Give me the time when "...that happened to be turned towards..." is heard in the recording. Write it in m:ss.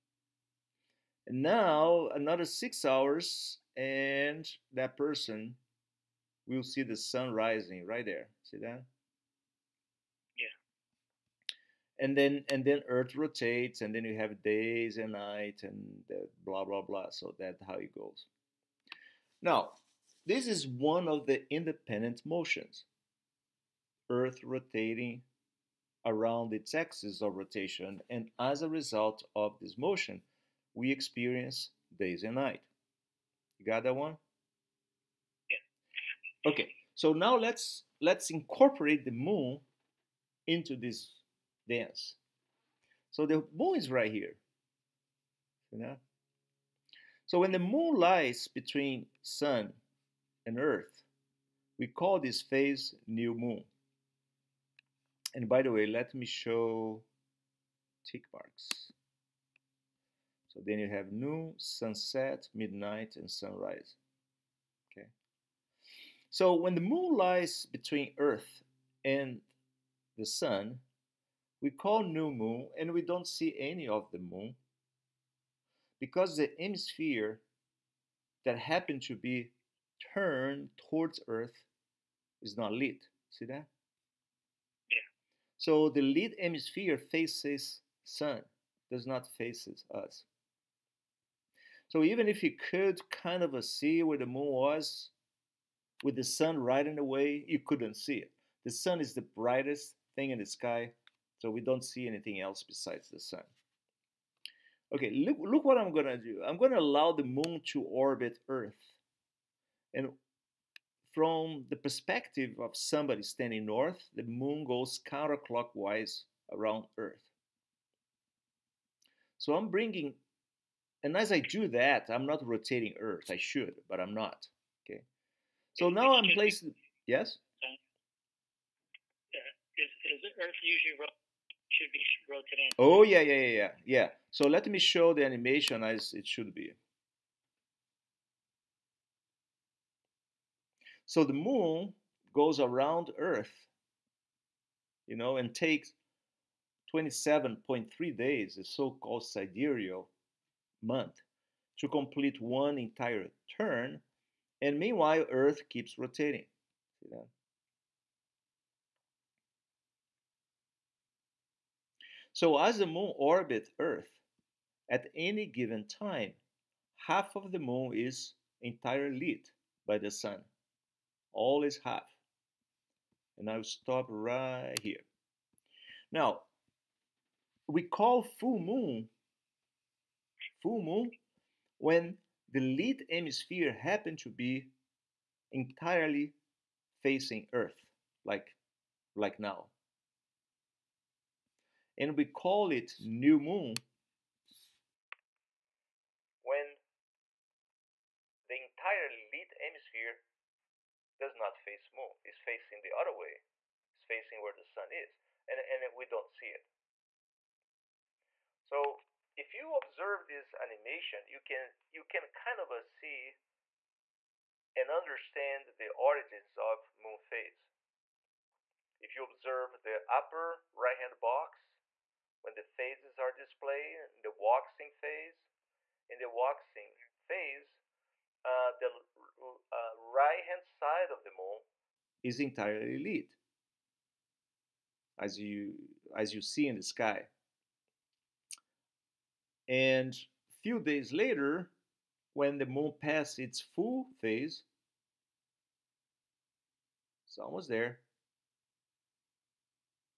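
1:18.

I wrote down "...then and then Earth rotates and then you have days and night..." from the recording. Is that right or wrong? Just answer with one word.
right.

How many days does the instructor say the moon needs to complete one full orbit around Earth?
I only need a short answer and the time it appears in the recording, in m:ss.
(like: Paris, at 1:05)
27.3 days, at 2:26.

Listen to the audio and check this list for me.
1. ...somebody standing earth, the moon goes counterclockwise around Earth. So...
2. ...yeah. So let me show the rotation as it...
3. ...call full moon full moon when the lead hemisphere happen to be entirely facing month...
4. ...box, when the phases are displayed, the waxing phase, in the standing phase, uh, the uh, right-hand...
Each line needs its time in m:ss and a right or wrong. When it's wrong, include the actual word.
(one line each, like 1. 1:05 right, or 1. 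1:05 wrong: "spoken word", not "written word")
1. 1:52 wrong: "north", not "earth"
2. 2:13 wrong: "animation", not "rotation"
3. 2:57 wrong: "earth", not "month"
4. 3:41 wrong: "waxing", not "standing".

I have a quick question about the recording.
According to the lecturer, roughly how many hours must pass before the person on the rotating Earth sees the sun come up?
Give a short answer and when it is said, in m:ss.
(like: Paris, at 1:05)
6 hours, at 0:02.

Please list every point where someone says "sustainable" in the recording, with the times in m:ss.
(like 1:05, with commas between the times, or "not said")
not said.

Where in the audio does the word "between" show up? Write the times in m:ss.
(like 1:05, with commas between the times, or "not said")
0:48, 1:07.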